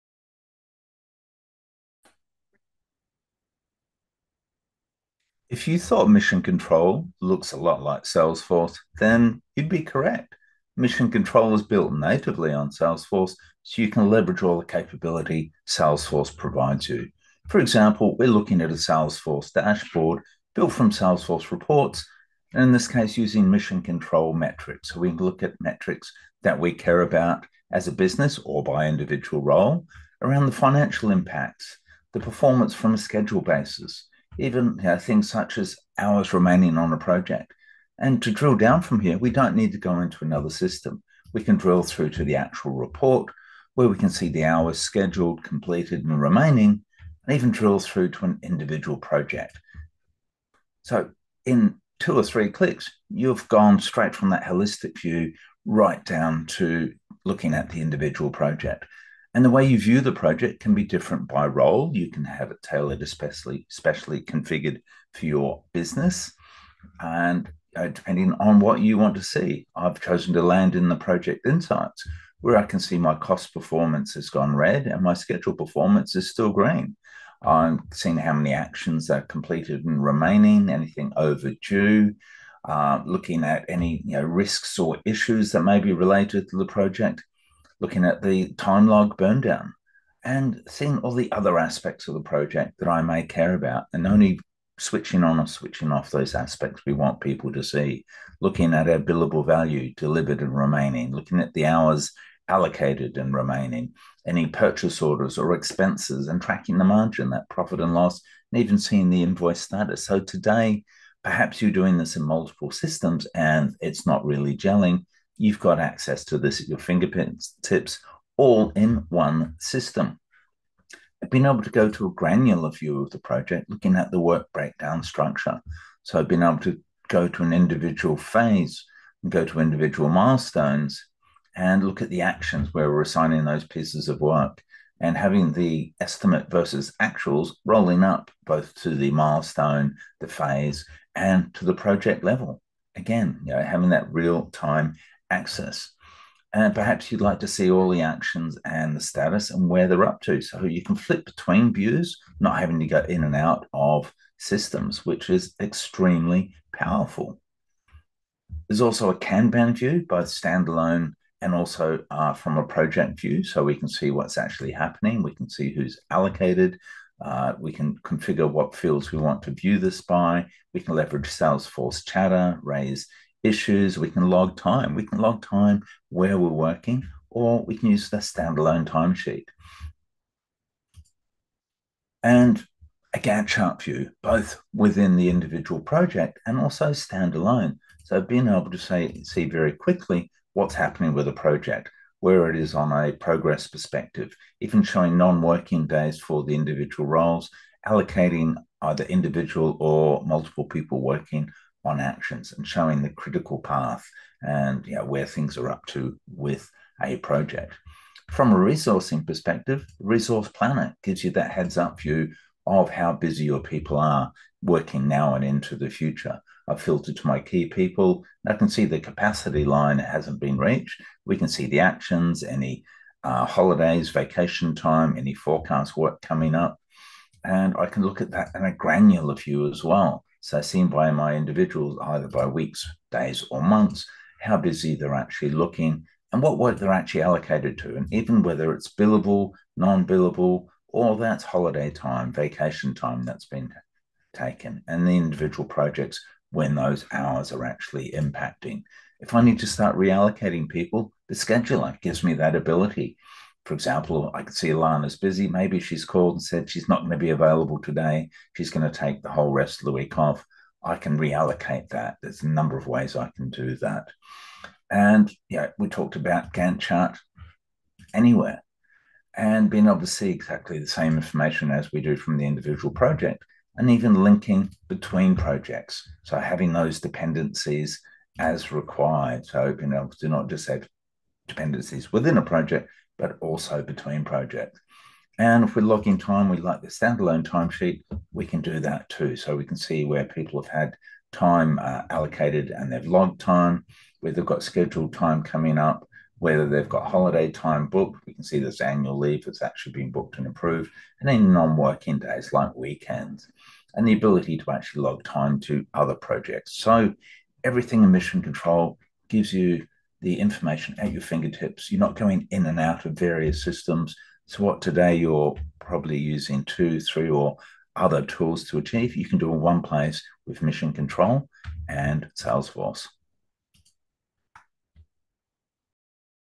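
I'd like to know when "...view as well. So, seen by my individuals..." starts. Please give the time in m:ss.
3:49.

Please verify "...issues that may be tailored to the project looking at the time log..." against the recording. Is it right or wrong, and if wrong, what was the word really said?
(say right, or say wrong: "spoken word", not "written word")
wrong: "related", not "tailored".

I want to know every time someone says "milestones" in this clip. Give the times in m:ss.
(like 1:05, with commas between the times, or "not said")
2:10, 2:19.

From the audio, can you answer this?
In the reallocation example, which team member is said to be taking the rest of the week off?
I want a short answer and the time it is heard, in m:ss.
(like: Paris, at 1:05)
Alana, at 4:14.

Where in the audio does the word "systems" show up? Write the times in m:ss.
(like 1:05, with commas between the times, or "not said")
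0:40, 1:52, 1:59, 2:34, 5:13.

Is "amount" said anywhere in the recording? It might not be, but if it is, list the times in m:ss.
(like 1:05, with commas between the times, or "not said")
not said.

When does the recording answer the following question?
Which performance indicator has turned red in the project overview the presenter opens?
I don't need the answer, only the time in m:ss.
1:12.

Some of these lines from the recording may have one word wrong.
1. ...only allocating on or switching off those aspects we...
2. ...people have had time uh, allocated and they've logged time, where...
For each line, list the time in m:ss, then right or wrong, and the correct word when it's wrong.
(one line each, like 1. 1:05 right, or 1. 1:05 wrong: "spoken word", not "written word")
1. 1:34 wrong: "switching", not "allocating"
2. 4:50 right.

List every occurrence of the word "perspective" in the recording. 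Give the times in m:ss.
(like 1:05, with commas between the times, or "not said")
3:13, 3:29.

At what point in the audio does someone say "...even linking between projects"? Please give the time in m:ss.
4:33.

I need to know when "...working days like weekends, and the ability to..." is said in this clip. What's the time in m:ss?
5:01.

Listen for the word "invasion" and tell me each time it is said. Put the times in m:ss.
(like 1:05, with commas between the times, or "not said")
not said.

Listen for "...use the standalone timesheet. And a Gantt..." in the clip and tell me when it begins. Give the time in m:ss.
2:57.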